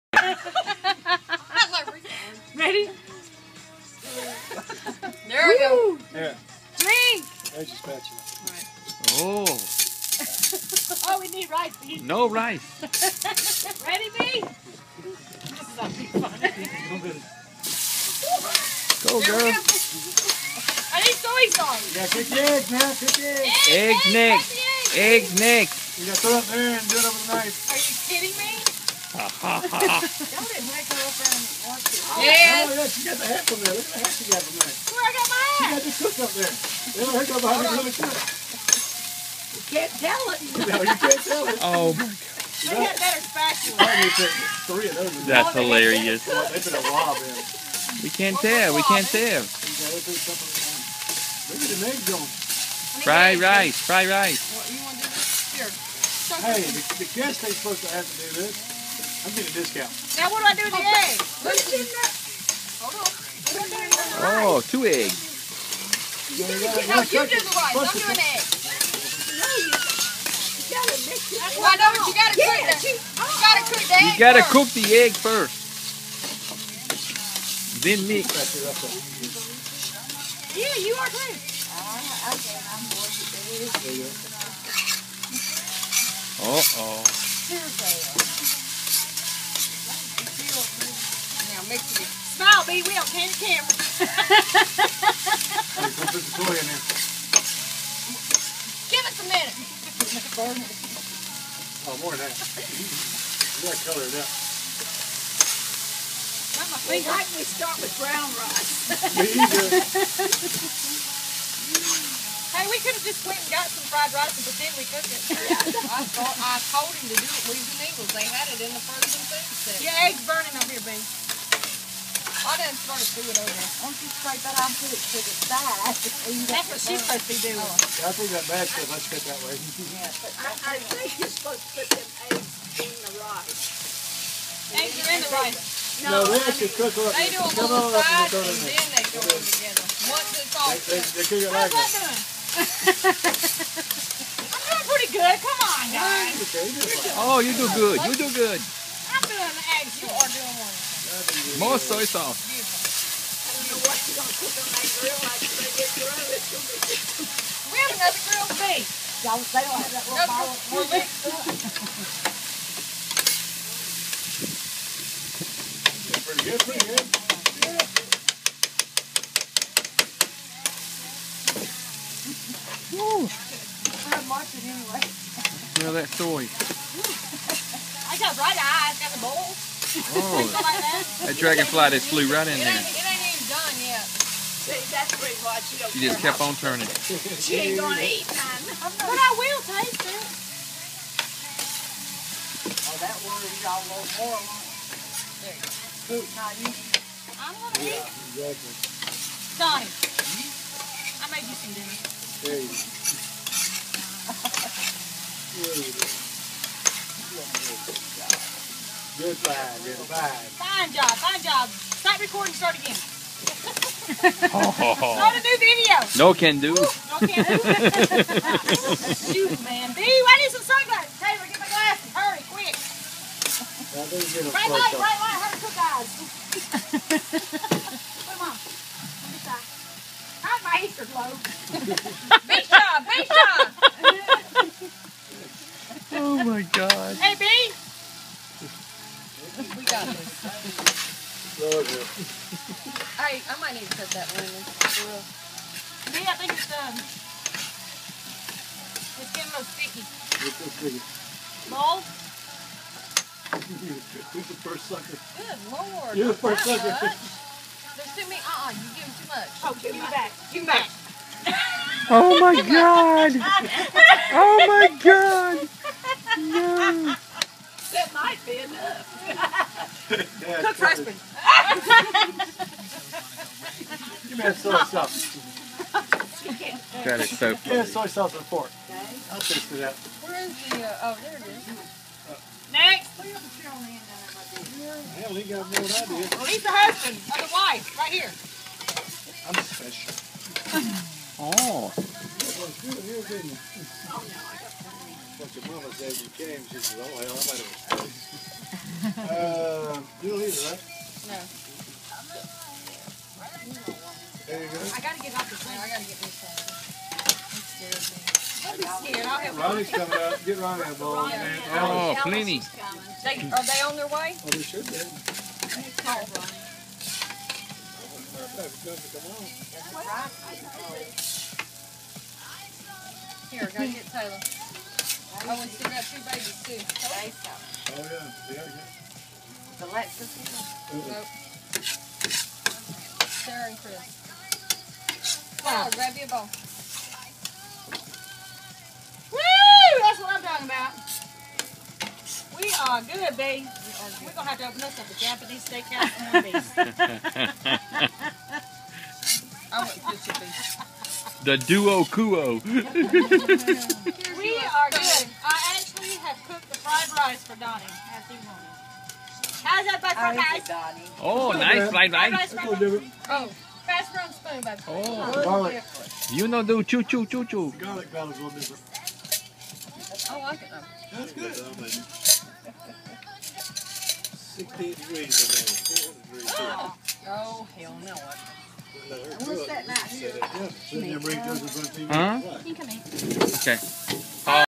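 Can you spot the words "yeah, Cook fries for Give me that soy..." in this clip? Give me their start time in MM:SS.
04:30.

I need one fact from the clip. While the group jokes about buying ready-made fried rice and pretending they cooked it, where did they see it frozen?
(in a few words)
England.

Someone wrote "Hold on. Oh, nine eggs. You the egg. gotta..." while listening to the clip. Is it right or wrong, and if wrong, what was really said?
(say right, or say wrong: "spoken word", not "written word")
wrong: "two", not "nine".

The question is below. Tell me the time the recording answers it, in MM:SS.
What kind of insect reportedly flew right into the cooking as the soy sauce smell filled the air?
03:01.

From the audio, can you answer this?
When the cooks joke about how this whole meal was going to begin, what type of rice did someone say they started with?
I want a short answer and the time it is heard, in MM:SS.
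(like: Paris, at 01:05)
brown rice, at 01:48.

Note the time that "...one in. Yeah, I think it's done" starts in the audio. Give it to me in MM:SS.
04:04.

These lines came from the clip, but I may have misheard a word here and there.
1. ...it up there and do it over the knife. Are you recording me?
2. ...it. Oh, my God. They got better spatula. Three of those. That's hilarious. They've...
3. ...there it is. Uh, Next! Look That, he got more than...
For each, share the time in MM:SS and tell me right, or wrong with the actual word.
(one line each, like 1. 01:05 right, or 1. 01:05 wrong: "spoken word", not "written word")
1. 00:26 wrong: "kidding", not "recording"
2. 00:41 right
3. 04:41 wrong: "Hell", not "That".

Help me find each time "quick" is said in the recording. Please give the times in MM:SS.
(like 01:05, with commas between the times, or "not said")
03:42.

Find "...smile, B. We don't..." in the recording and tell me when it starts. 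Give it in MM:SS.
01:32.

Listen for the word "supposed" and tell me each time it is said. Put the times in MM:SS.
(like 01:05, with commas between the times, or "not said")
00:57, 02:06, 02:11.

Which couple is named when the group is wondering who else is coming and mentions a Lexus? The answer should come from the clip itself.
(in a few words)
Sarah and Chris.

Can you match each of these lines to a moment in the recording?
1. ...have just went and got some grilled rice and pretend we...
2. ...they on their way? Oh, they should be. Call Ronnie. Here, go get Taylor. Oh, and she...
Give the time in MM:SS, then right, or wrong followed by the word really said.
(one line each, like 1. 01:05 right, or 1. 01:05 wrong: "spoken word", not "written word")
1. 01:52 wrong: "fried", not "grilled"
2. 05:13 right.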